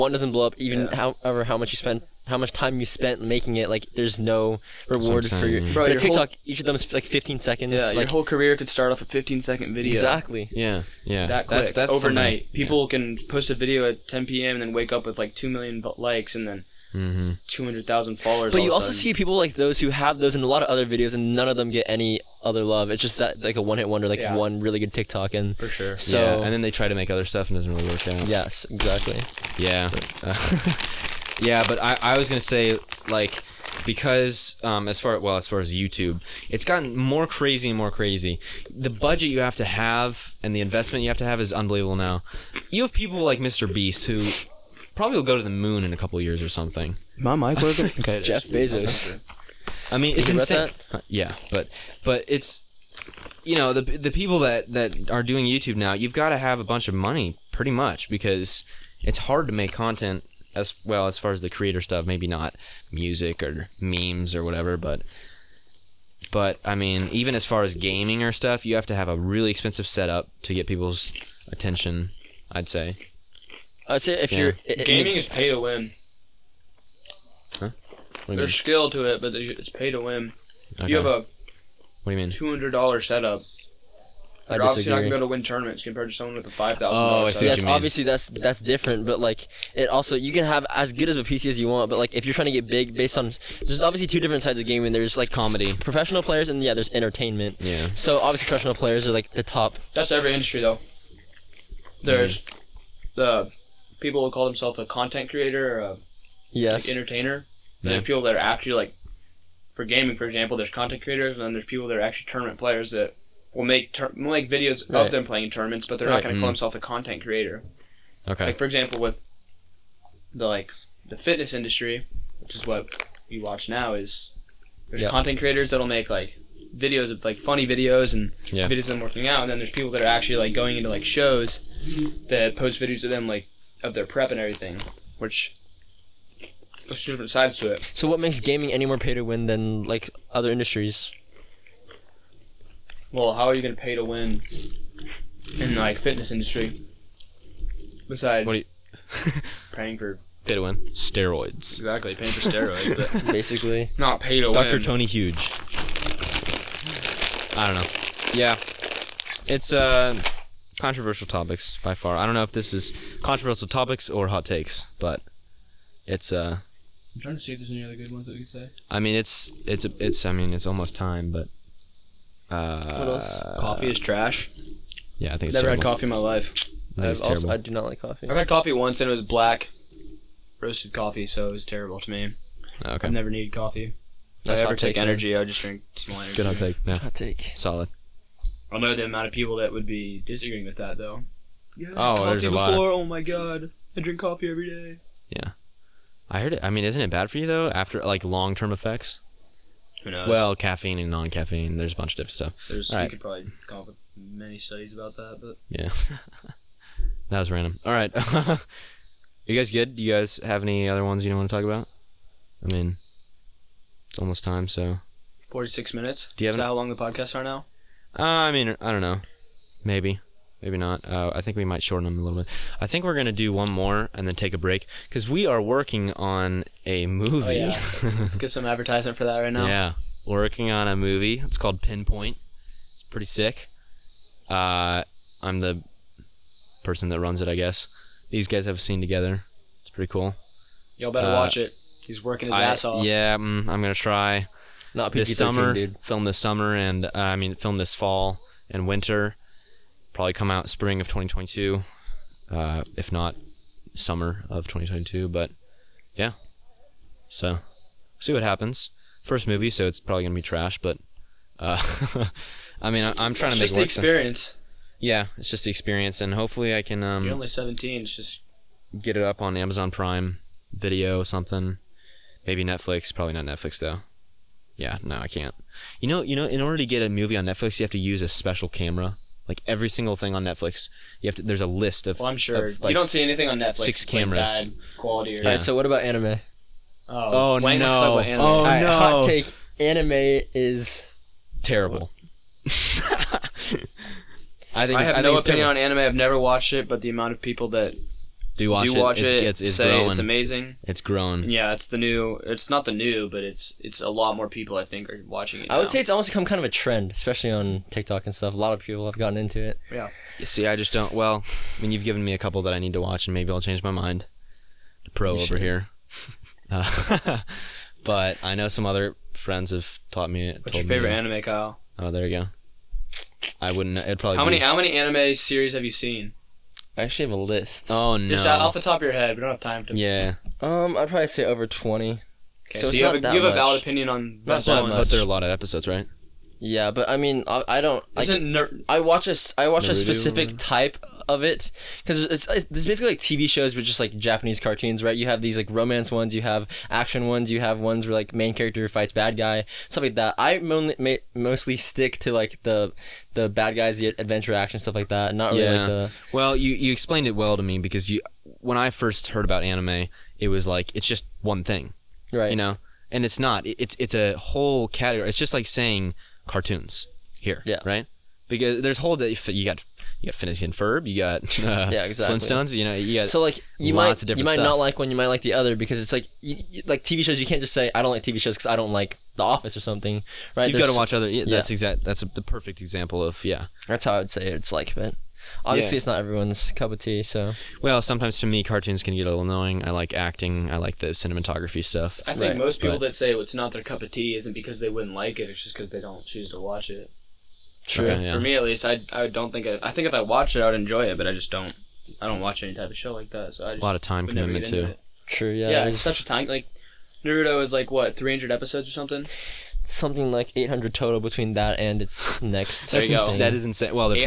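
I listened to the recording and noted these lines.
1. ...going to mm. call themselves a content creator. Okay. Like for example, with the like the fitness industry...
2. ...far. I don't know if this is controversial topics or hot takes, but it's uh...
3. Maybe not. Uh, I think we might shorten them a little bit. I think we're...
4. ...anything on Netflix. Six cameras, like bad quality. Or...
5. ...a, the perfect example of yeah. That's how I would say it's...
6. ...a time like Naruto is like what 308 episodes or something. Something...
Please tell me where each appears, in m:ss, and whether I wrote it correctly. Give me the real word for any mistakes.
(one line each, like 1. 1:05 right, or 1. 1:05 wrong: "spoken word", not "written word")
1. 1:56 right
2. 2:41 right
3. 3:40 right
4. 4:43 right
5. 6:22 right
6. 6:46 wrong: "300", not "308".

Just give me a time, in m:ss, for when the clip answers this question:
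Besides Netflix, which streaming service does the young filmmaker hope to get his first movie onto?
4:29.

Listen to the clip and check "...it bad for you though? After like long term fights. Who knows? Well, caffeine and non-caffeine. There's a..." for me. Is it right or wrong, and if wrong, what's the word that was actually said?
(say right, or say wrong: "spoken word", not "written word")
wrong: "effects", not "fights".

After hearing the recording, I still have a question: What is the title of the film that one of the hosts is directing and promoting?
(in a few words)
Pinpoint.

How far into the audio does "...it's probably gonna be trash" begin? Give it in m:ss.
4:19.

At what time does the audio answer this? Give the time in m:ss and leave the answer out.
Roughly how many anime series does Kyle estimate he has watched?
5:31.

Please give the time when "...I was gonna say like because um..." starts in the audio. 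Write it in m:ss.
0:32.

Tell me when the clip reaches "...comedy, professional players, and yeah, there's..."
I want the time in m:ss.
1:35.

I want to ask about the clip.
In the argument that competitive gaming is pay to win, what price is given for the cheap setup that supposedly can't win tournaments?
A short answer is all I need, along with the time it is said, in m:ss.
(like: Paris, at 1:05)
$200, at 1:22.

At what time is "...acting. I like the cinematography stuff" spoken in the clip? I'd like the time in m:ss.
6:30.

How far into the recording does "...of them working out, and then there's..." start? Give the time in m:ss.
2:08.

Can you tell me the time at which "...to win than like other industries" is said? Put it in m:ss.
2:19.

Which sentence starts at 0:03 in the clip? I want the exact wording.
Like, there's no reward for your.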